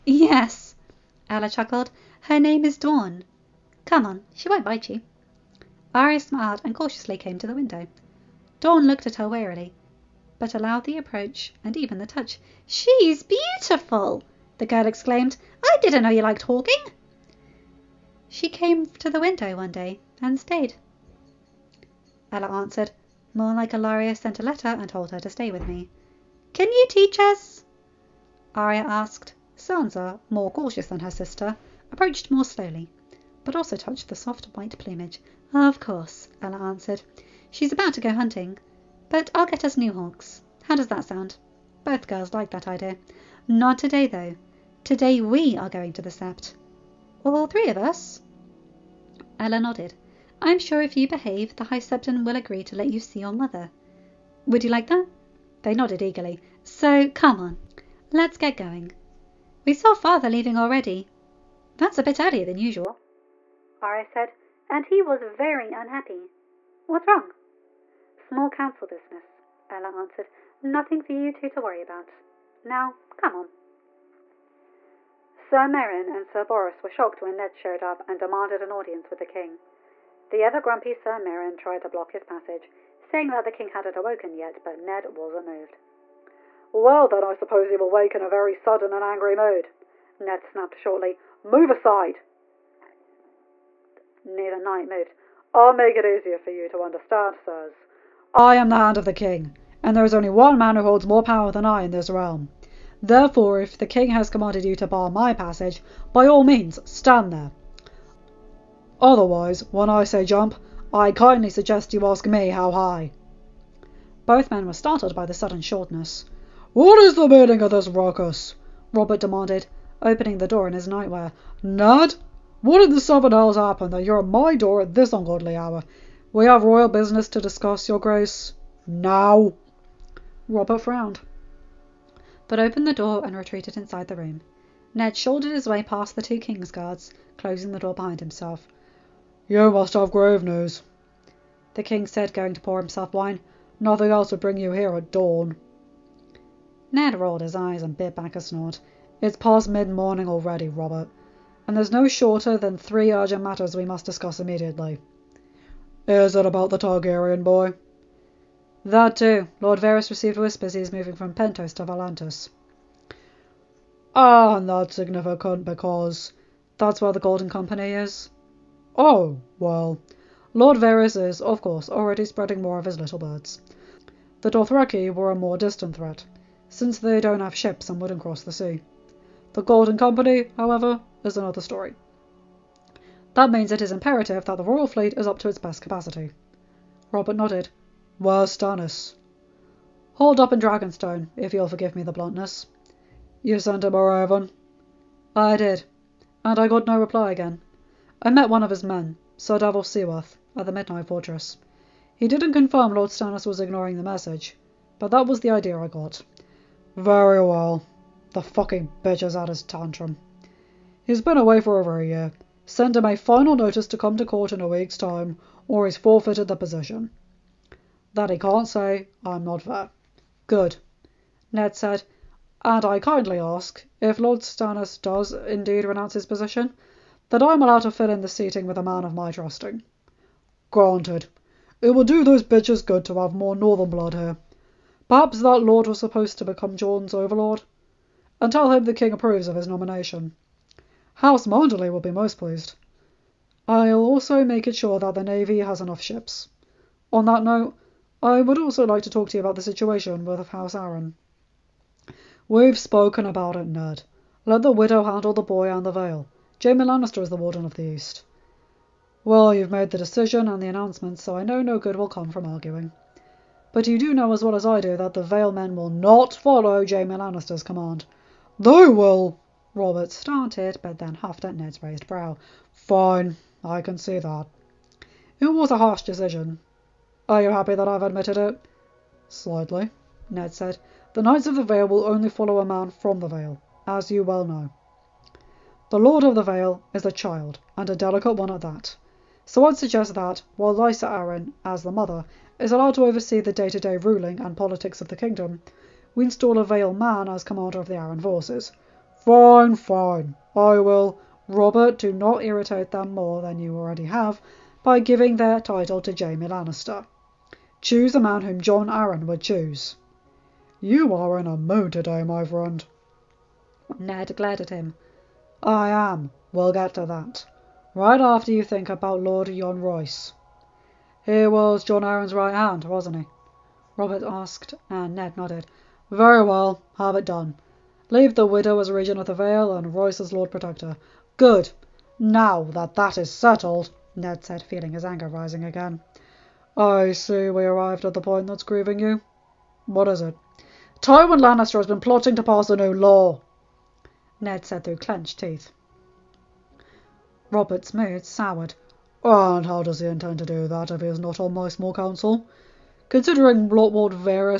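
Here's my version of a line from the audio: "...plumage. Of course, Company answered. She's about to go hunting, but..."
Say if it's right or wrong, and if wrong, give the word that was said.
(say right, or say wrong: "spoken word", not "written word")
wrong: "Ella", not "Company".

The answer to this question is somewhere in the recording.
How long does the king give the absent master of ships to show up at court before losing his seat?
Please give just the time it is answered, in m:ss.
3:34.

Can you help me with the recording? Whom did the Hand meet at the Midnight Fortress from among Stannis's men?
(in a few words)
Sir Davos Seaworth.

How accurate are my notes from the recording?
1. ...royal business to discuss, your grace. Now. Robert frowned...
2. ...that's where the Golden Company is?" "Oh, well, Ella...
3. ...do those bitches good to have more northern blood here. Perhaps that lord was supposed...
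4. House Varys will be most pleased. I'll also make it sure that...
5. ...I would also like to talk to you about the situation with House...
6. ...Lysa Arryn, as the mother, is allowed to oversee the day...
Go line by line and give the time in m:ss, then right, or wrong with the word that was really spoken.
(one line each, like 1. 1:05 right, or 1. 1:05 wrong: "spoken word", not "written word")
1. 2:06 right
2. 2:46 wrong: "Lord", not "Ella"
3. 3:52 right
4. 4:01 wrong: "Manderley", not "Varys"
5. 4:08 right
6. 4:50 right.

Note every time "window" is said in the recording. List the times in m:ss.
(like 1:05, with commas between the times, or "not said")
0:07, 0:19.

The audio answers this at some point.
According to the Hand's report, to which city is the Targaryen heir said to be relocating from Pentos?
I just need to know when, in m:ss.
2:41.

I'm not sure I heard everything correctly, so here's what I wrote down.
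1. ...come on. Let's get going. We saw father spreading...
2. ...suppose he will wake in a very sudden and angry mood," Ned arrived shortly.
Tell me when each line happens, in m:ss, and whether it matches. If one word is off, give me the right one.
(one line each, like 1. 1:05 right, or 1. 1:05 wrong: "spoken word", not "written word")
1. 0:57 wrong: "leaving", not "spreading"
2. 1:27 wrong: "snapped", not "arrived".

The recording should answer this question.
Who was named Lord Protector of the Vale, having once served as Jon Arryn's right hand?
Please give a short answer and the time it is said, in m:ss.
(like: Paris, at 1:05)
John Royce, at 5:19.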